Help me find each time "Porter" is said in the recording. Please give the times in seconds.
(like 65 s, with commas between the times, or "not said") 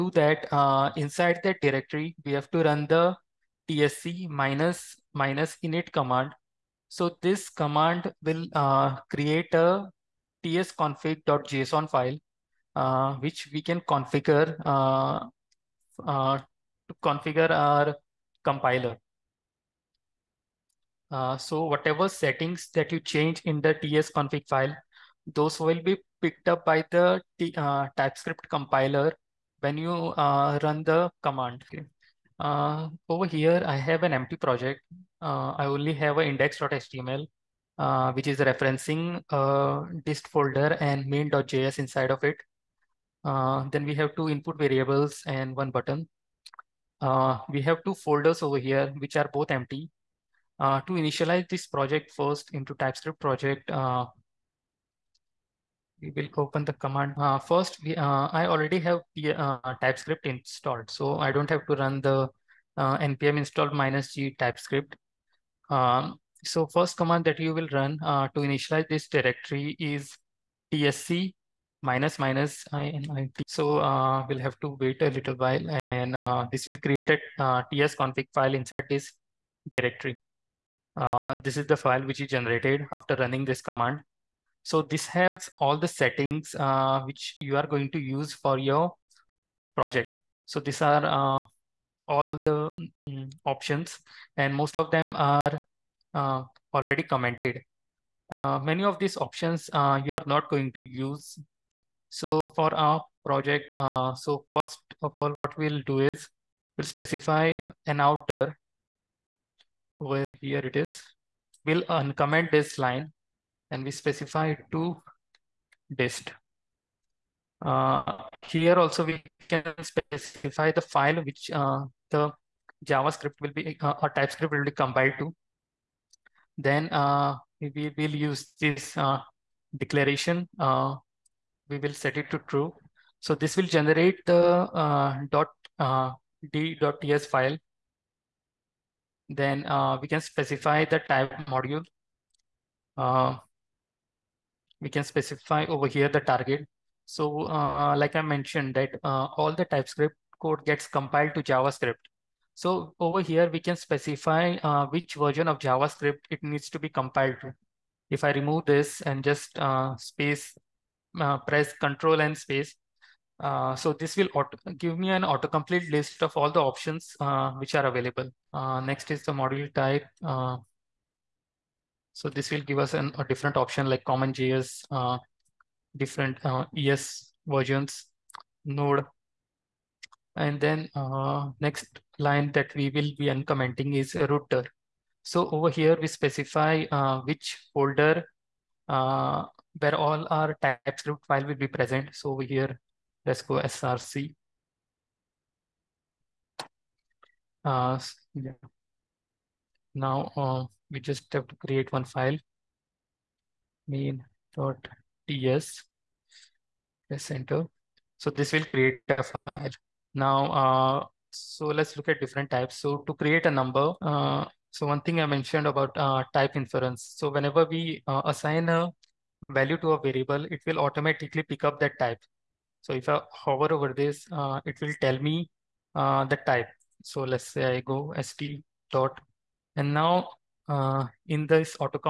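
not said.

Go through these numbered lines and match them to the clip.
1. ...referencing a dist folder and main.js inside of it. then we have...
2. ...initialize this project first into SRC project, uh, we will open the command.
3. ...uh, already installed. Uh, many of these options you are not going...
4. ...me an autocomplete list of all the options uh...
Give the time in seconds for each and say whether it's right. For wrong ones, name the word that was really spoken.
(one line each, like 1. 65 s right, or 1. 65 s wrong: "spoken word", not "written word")
1. 38 s right
2. 50 s wrong: "TypeScript", not "SRC"
3. 96 s wrong: "commented", not "installed"
4. 164 s right.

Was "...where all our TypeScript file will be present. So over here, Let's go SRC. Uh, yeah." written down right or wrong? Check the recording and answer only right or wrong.
right.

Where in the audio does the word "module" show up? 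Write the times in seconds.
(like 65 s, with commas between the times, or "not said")
141 s, 169 s.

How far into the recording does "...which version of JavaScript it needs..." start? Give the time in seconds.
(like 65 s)
154 s.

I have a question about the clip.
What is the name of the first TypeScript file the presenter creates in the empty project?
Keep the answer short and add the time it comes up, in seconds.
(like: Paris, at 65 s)
main.ts, at 203 s.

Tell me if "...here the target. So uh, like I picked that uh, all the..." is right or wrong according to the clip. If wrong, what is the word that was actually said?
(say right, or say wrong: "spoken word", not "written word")
wrong: "mentioned", not "picked".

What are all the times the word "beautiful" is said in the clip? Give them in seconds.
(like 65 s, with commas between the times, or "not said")
not said.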